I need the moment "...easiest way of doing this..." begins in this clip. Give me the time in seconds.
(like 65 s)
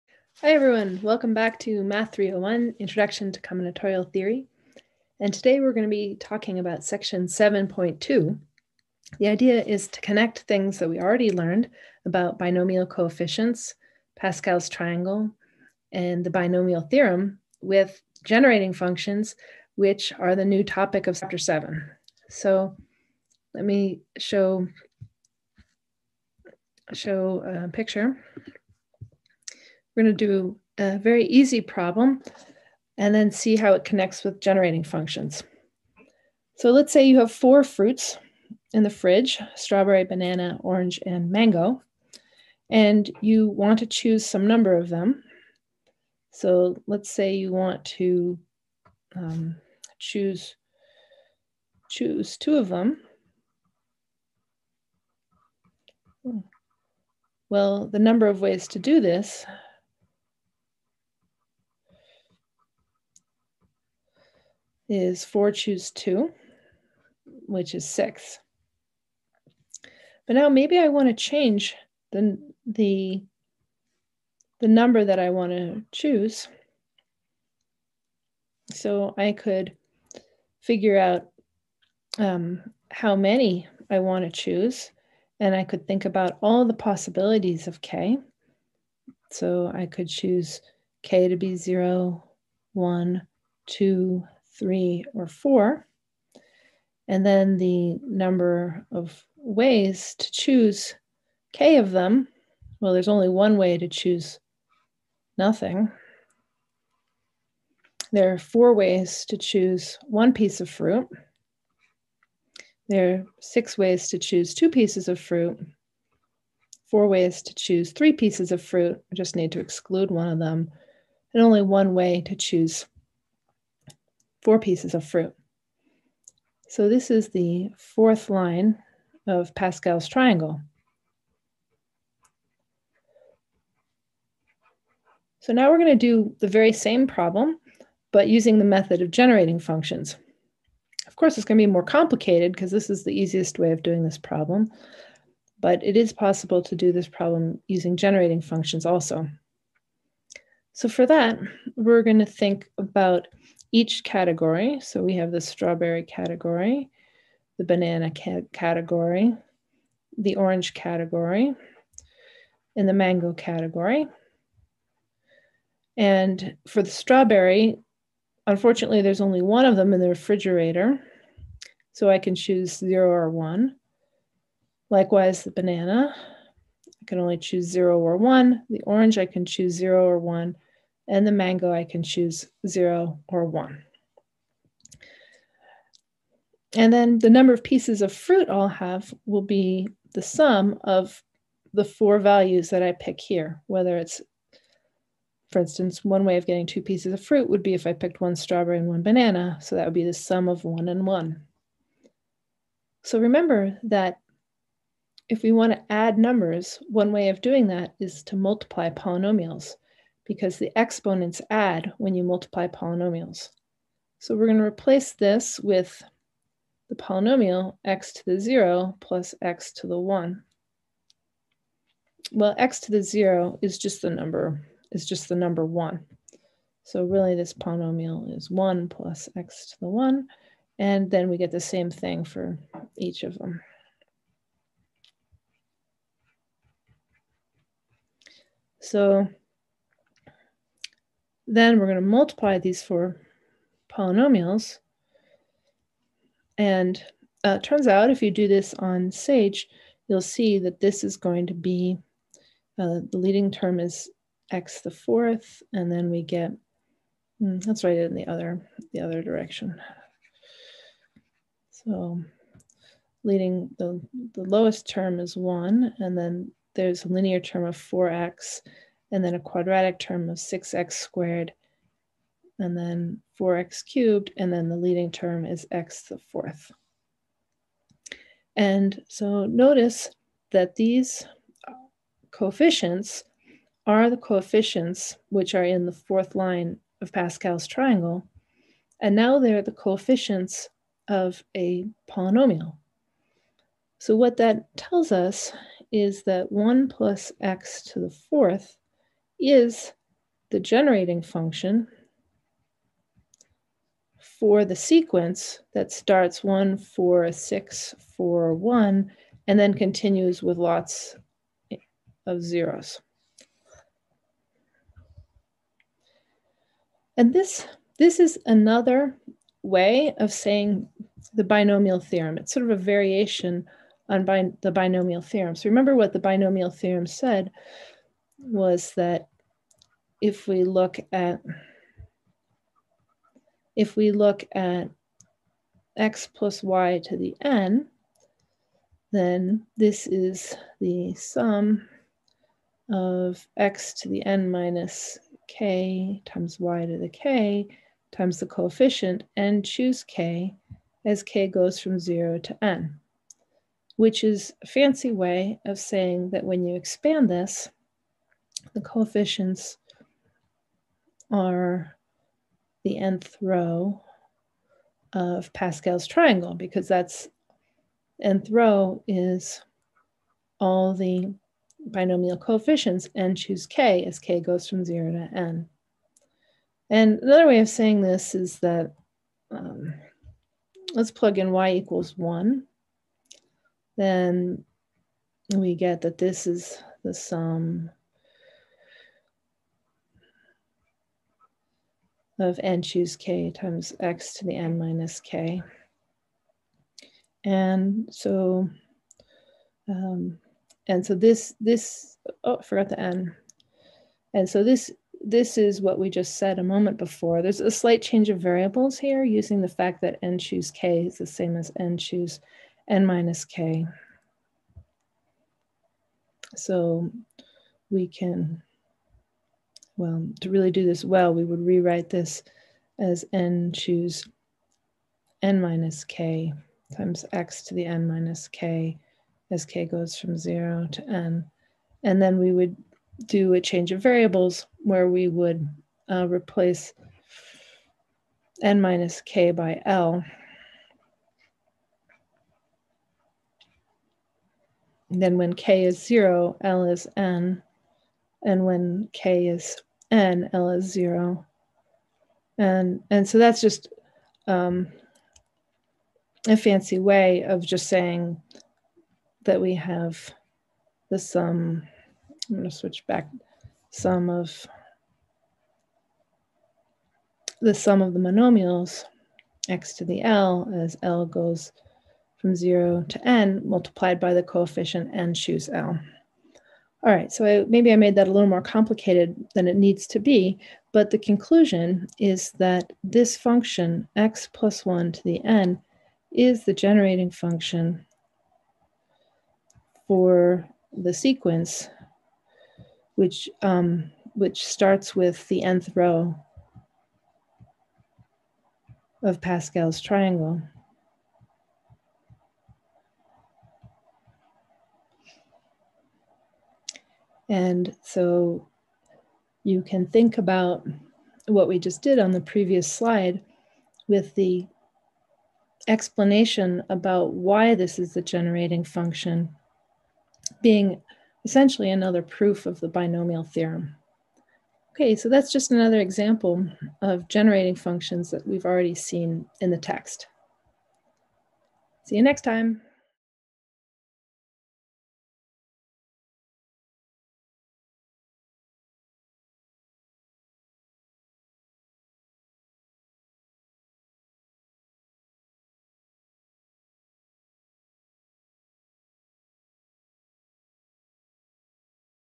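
143 s.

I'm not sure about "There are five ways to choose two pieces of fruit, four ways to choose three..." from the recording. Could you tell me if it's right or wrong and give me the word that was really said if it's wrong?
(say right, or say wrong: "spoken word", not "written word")
wrong: "six", not "five".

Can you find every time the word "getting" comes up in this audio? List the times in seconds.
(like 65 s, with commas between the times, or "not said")
196 s.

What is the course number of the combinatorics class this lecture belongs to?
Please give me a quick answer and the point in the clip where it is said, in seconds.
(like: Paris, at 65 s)
301, at 2 s.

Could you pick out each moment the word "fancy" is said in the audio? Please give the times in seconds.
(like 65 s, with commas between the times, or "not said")
354 s, 456 s.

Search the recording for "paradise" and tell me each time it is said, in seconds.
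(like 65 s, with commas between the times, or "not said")
not said.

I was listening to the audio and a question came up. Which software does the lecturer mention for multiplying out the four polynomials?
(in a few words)
SAGE.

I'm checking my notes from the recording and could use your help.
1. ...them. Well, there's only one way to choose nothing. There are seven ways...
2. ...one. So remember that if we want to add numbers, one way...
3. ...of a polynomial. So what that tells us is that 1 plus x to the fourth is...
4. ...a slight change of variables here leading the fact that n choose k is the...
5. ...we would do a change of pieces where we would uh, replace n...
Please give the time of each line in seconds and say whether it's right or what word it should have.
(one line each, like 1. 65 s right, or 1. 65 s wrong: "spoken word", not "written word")
1. 101 s wrong: "four", not "seven"
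2. 201 s right
3. 291 s right
4. 407 s wrong: "using", not "leading"
5. 432 s wrong: "variables", not "pieces".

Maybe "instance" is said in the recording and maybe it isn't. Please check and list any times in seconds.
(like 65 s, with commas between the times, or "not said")
195 s.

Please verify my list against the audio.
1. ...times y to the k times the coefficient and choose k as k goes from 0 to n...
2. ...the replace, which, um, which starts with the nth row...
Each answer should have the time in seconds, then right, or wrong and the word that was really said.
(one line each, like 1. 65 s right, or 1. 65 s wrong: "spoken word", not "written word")
1. 346 s right
2. 490 s wrong: "sequence", not "replace".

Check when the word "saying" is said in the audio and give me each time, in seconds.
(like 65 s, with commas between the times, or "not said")
320 s, 355 s, 377 s, 457 s.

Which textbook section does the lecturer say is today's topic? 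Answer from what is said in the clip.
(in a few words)
7.2.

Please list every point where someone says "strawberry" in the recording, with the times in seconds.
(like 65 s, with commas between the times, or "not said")
39 s, 155 s, 166 s, 198 s.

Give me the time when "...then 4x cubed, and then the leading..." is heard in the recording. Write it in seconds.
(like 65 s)
272 s.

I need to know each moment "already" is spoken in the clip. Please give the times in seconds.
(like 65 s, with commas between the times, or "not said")
10 s, 528 s.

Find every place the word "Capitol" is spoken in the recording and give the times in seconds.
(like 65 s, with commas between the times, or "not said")
not said.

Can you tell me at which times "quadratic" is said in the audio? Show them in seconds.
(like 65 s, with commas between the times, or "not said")
269 s.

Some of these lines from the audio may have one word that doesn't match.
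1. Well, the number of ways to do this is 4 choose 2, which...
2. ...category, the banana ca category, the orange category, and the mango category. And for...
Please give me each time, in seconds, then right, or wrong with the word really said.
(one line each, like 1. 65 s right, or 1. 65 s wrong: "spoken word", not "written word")
1. 57 s right
2. 156 s right.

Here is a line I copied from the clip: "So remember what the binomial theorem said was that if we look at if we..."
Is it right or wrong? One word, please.
right.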